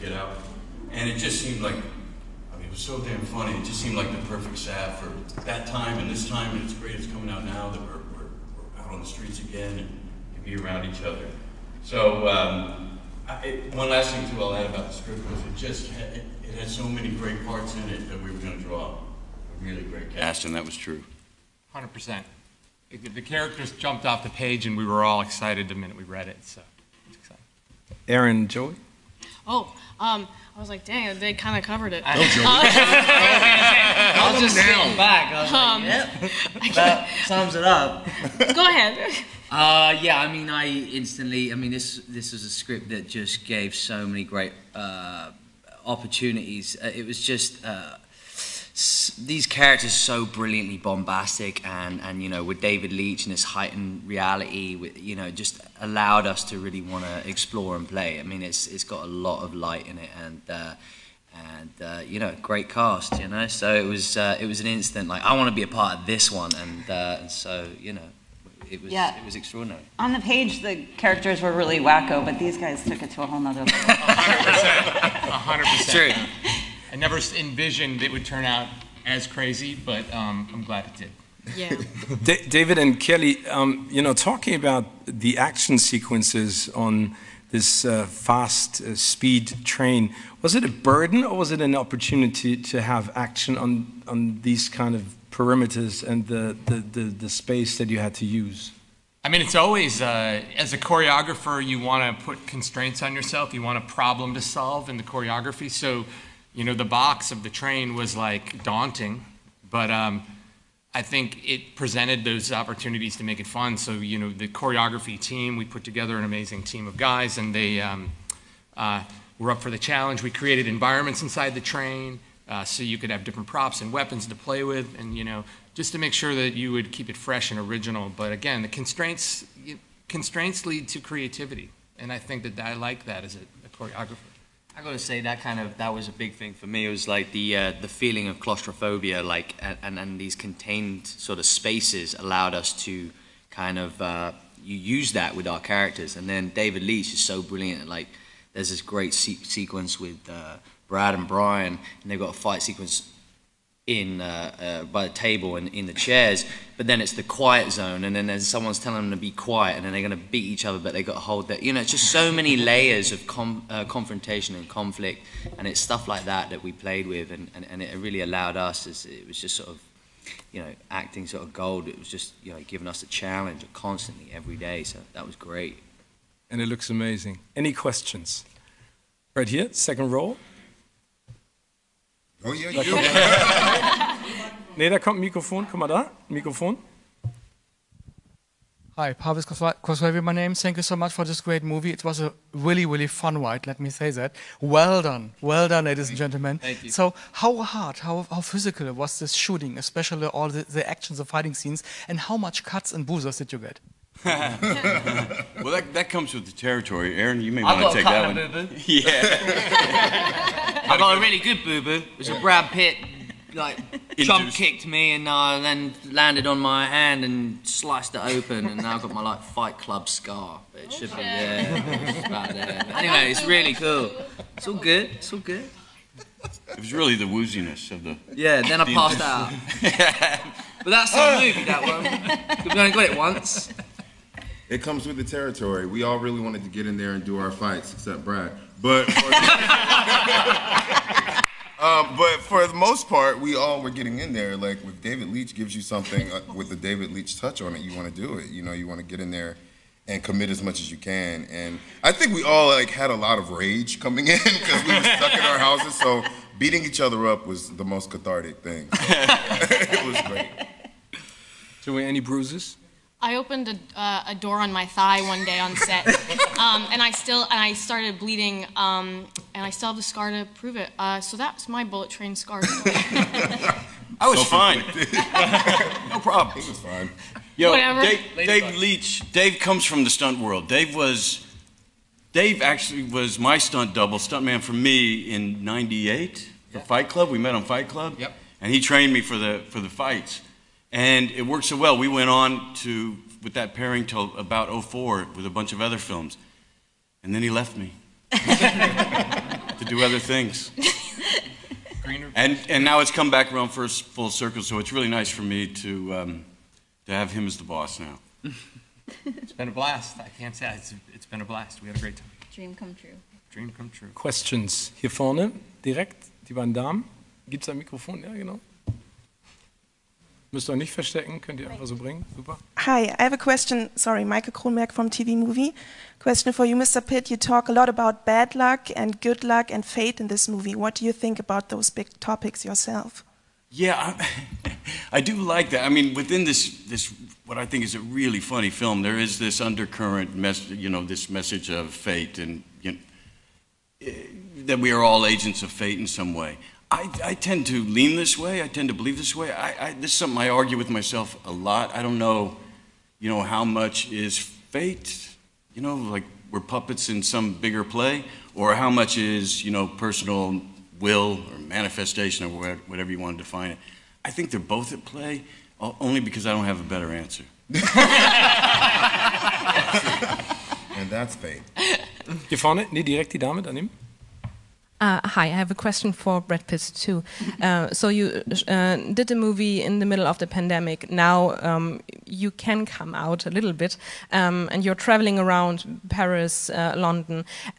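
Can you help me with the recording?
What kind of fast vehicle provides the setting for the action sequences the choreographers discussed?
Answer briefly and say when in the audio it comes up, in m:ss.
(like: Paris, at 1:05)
speed train, at 1:28.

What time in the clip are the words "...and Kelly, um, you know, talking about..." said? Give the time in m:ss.
1:22.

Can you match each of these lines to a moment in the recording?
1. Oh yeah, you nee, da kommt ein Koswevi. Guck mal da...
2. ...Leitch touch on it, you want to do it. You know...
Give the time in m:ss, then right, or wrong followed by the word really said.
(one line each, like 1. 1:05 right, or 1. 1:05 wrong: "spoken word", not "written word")
1. 3:02 wrong: "Mikrofon", not "Koswevi"
2. 4:07 right.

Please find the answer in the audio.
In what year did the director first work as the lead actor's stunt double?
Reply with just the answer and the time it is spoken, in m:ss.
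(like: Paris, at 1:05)
1998, at 4:45.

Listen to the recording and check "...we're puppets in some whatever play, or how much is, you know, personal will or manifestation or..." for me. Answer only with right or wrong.
wrong.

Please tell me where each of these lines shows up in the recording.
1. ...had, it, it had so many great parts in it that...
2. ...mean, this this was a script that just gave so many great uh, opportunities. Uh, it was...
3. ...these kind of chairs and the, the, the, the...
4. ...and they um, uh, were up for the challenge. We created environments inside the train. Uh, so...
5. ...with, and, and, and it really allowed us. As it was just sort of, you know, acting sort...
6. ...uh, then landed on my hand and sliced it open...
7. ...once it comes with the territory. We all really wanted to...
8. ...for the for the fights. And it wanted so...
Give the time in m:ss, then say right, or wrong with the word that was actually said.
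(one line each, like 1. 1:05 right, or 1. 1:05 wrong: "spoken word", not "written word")
1. 0:15 right
2. 0:41 right
3. 1:34 wrong: "perimeters", not "chairs"
4. 1:57 right
5. 2:47 right
6. 3:35 right
7. 3:53 right
8. 4:49 wrong: "worked", not "wanted".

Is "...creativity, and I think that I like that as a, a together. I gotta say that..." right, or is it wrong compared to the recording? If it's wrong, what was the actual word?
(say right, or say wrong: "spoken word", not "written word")
wrong: "choreographer", not "together".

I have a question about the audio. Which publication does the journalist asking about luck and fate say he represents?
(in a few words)
TV Movie.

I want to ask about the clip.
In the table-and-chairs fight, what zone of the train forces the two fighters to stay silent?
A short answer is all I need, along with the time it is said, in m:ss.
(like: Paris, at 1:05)
the quiet zone, at 2:37.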